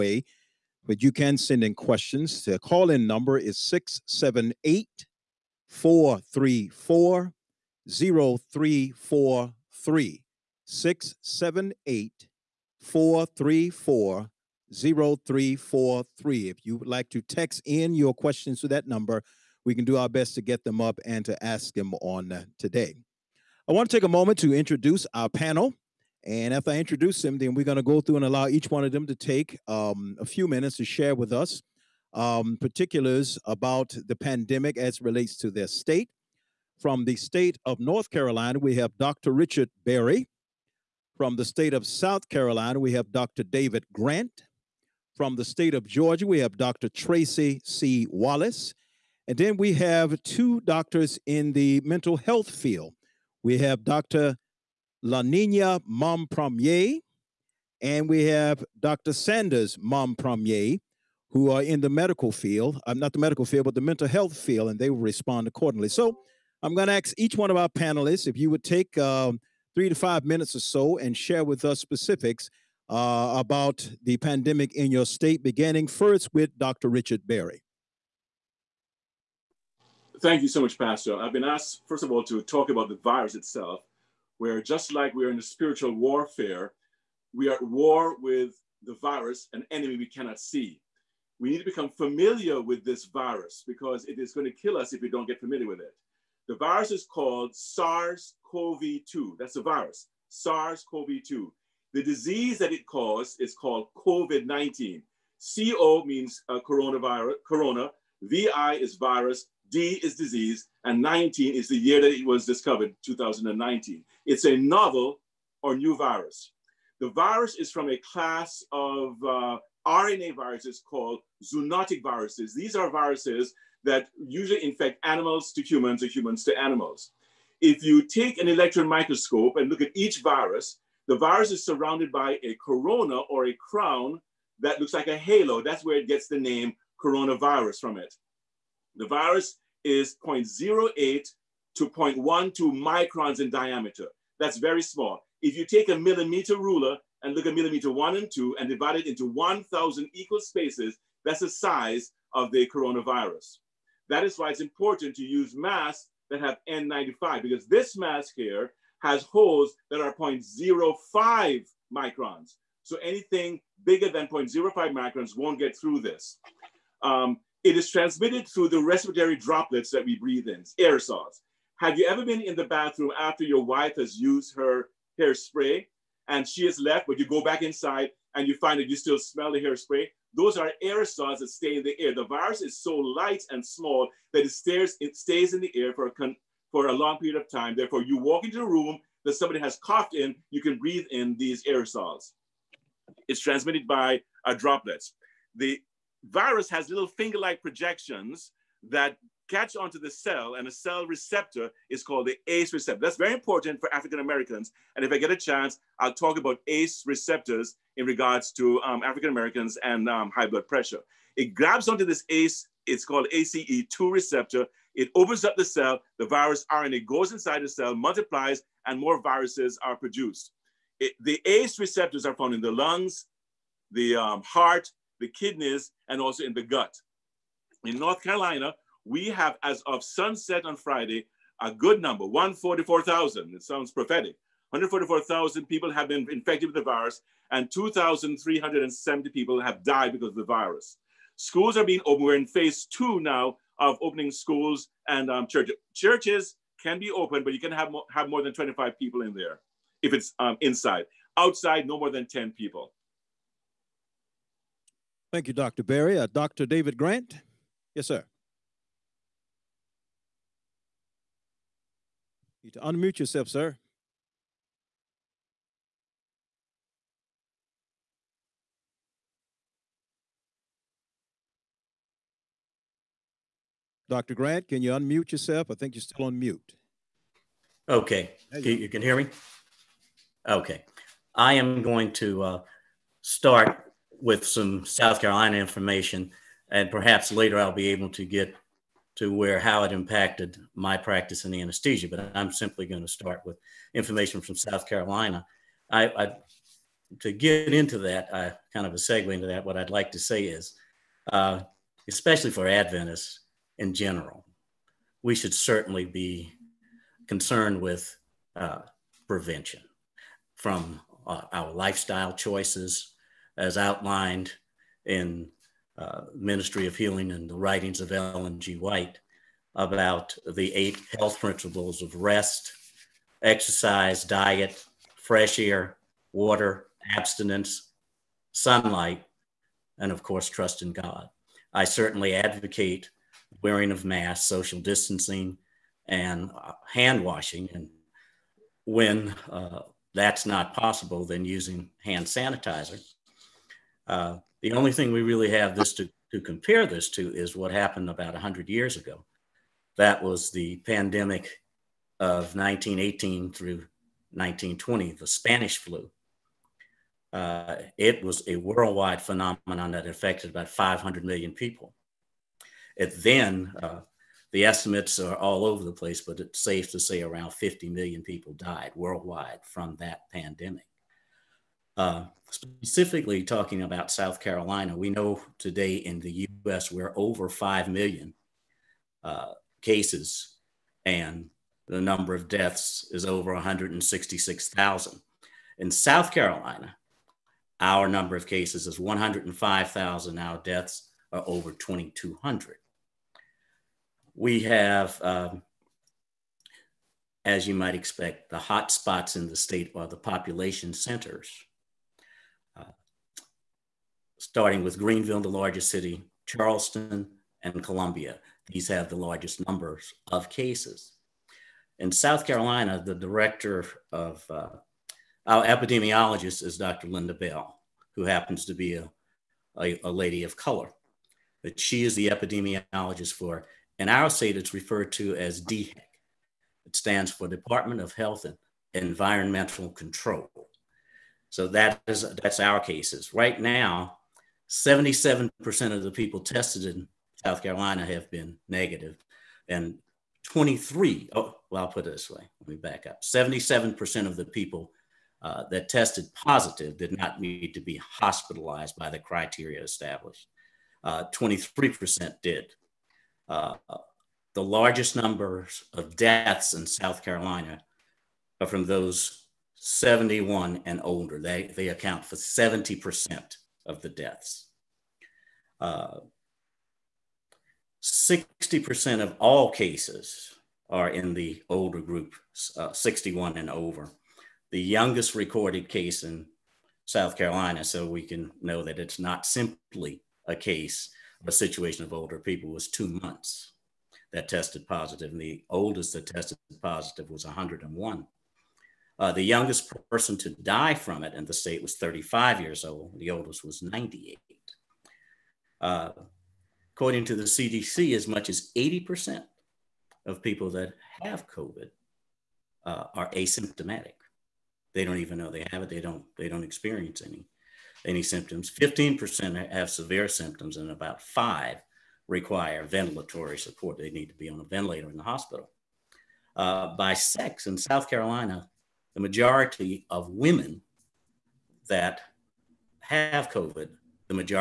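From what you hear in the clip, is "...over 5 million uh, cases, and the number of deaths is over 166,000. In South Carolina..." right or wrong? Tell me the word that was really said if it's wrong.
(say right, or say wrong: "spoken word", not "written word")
right.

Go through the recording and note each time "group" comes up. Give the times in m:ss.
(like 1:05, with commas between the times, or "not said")
7:52.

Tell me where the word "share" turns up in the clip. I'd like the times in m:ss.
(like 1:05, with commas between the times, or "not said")
0:30, 1:11.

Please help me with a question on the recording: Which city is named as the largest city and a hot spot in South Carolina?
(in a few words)
Greenville.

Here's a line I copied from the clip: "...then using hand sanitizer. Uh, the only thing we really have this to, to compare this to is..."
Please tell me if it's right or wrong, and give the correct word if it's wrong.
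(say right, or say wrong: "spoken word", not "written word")
right.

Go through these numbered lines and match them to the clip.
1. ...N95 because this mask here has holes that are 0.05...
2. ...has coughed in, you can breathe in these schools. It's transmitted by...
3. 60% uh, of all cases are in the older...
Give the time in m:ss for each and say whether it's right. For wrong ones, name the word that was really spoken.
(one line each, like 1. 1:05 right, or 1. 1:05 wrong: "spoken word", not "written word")
1. 2:36 right
2. 3:09 wrong: "aerosols", not "schools"
3. 7:45 right.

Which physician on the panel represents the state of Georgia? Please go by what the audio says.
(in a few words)
Dr. Tracy C. Wallace.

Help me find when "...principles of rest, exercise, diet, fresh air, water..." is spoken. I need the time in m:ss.
5:21.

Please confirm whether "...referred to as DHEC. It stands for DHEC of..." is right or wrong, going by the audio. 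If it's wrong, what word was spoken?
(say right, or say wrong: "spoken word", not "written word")
wrong: "Department", not "DHEC".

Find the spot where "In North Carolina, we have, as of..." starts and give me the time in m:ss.
3:47.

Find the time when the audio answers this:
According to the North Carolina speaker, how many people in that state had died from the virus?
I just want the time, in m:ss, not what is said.
3:57.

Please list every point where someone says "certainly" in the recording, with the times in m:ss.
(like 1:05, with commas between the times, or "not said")
5:05, 5:31.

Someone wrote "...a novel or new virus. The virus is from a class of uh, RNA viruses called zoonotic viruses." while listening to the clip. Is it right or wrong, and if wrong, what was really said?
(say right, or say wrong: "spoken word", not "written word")
right.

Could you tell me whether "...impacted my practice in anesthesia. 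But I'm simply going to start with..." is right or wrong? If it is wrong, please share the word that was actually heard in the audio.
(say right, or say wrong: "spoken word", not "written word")
right.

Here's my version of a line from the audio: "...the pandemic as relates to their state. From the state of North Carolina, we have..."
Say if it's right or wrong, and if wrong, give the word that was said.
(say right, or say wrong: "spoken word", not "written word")
right.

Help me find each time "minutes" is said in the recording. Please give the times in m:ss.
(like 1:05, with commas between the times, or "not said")
0:30, 1:10.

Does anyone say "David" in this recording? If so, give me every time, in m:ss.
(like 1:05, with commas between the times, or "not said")
0:43, 4:16.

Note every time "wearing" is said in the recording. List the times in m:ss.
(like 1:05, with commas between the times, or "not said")
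5:33.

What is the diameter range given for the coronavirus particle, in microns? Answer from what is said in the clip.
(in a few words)
0.08 to 0.12 microns.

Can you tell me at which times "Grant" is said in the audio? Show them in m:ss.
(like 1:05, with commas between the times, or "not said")
0:43, 4:16, 4:34.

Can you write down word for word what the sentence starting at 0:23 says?
I want to take a moment to introduce our panel.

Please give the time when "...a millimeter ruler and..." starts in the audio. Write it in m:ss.
2:25.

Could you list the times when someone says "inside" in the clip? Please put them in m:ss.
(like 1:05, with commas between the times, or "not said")
2:57, 3:37, 4:10.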